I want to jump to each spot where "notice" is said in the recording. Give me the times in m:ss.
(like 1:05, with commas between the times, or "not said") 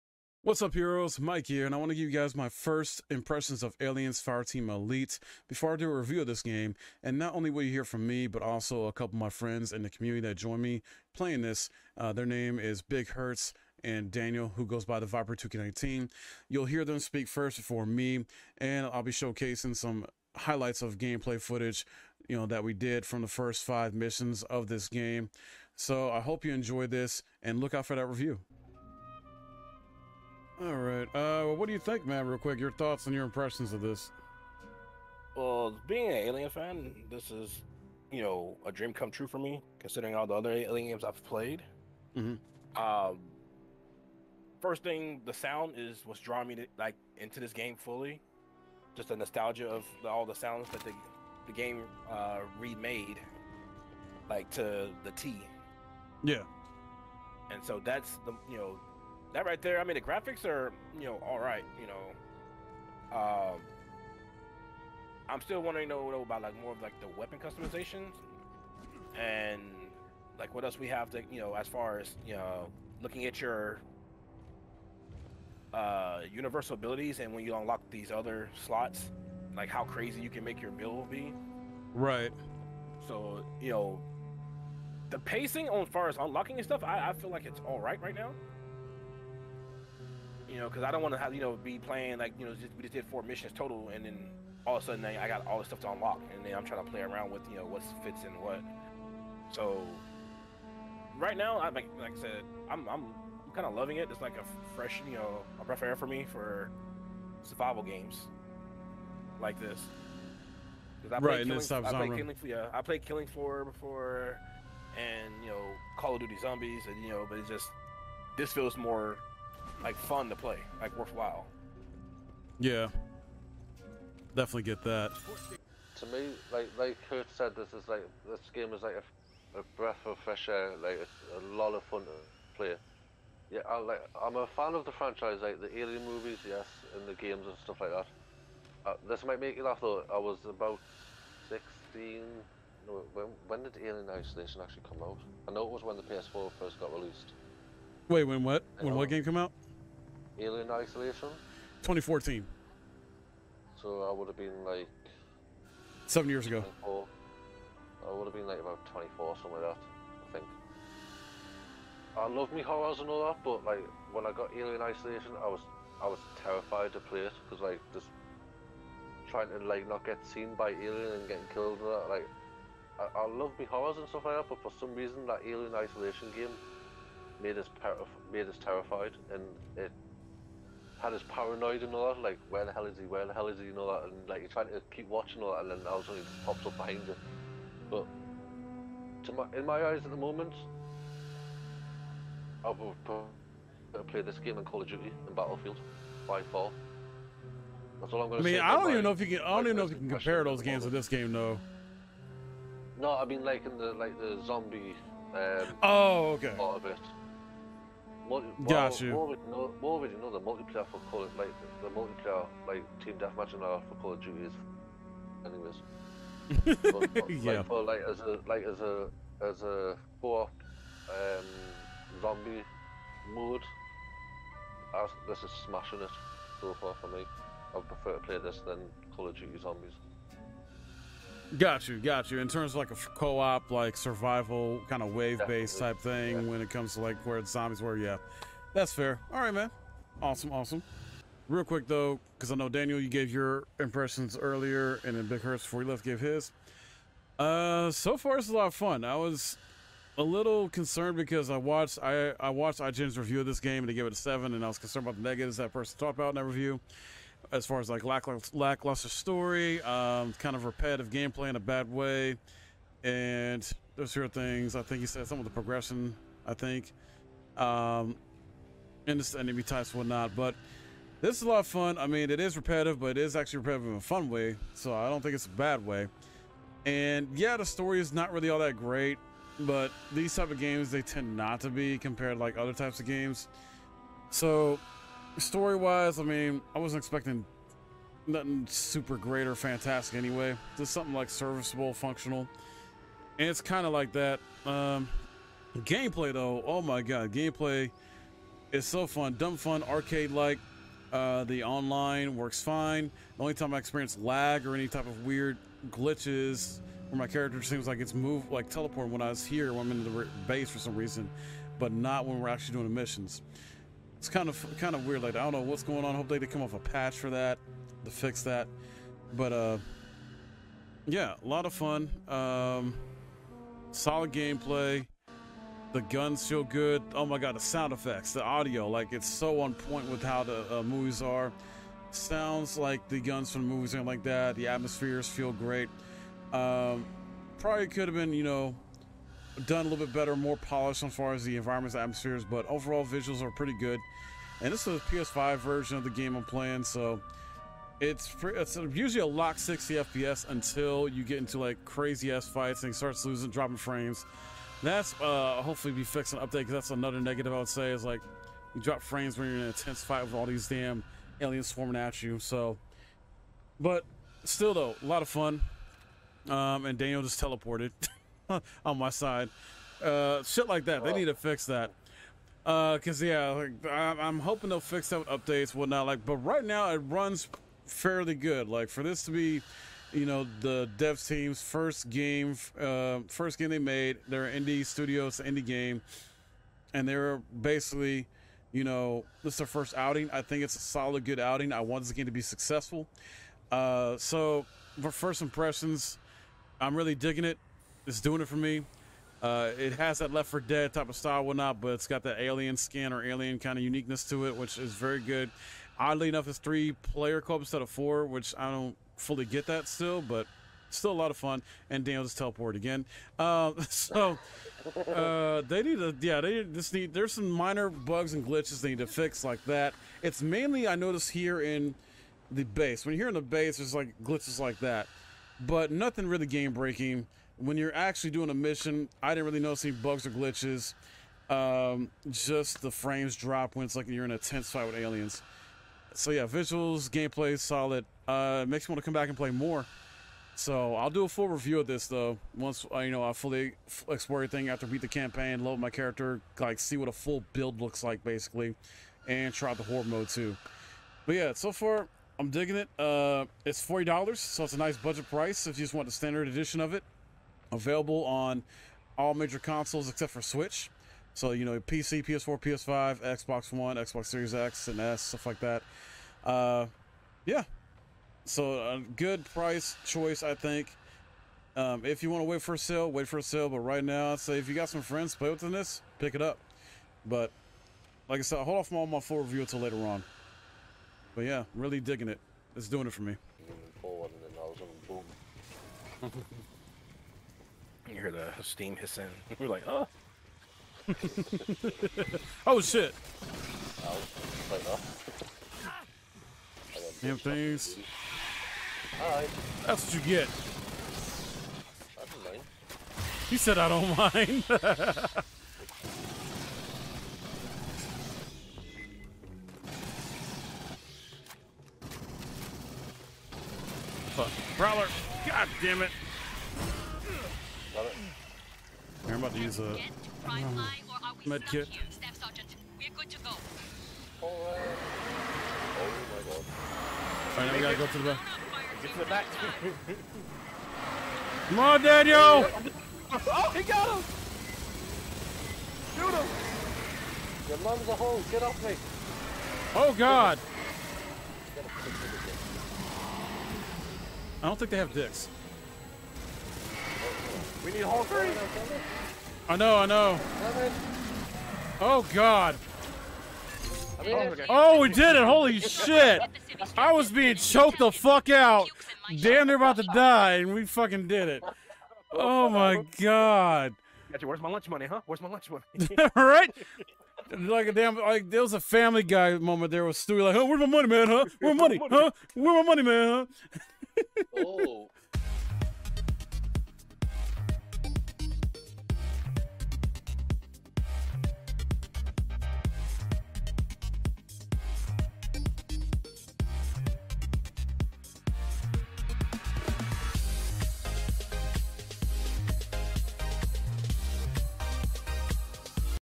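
7:00, 7:09.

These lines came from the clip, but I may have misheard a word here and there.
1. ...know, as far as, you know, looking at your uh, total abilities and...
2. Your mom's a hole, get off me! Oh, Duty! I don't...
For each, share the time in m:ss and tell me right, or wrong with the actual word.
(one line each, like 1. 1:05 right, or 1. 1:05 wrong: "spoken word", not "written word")
1. 1:11 wrong: "universal", not "total"
2. 8:57 wrong: "God", not "Duty".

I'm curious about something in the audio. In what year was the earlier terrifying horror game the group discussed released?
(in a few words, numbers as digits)
2014.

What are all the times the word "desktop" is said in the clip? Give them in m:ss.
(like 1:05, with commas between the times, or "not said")
not said.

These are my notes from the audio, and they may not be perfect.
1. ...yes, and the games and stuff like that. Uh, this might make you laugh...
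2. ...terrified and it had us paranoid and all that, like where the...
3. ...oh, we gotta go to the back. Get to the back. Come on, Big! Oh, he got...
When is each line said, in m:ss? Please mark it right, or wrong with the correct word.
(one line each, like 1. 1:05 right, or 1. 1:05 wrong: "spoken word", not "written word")
1. 2:16 right
2. 2:58 right
3. 8:47 wrong: "Daniel", not "Big".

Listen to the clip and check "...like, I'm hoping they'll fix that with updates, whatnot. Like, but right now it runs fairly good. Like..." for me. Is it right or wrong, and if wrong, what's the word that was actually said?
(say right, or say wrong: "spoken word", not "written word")
right.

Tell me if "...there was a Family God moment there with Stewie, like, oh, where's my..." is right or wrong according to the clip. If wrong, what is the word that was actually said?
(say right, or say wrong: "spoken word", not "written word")
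wrong: "Guy", not "God".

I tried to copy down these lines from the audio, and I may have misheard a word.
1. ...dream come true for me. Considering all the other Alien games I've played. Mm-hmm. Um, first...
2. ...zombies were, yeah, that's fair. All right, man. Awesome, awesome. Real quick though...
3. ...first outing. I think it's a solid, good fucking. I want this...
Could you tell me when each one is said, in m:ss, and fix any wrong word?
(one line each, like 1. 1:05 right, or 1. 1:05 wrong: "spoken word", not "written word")
1. 0:38 right
2. 3:57 right
3. 6:29 wrong: "outing", not "fucking".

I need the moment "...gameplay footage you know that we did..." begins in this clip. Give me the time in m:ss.
0:20.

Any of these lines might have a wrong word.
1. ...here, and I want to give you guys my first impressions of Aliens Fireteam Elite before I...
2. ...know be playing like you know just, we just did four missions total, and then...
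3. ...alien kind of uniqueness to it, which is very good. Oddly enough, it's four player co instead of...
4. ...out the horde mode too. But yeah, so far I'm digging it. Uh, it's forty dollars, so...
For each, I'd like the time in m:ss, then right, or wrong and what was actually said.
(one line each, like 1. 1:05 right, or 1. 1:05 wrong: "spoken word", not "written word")
1. 0:01 right
2. 1:31 right
3. 6:43 wrong: "three", not "four"
4. 7:29 right.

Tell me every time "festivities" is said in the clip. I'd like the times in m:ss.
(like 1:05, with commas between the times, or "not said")
not said.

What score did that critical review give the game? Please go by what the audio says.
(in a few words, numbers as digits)
7.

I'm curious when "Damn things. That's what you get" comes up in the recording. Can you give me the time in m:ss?
8:17.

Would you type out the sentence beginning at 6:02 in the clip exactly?
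So, but still though, a lot of fun.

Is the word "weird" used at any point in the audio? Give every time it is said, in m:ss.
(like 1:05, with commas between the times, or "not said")
5:05, 5:15.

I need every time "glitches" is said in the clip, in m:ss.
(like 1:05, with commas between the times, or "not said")
5:05, 6:58, 7:04, 7:10.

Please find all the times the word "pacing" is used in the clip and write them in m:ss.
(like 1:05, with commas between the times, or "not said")
1:25.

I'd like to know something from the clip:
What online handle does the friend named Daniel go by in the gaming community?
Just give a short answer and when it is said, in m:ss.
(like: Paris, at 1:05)
the Viper 2K19, at 0:14.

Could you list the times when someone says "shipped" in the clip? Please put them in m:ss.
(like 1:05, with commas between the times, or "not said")
not said.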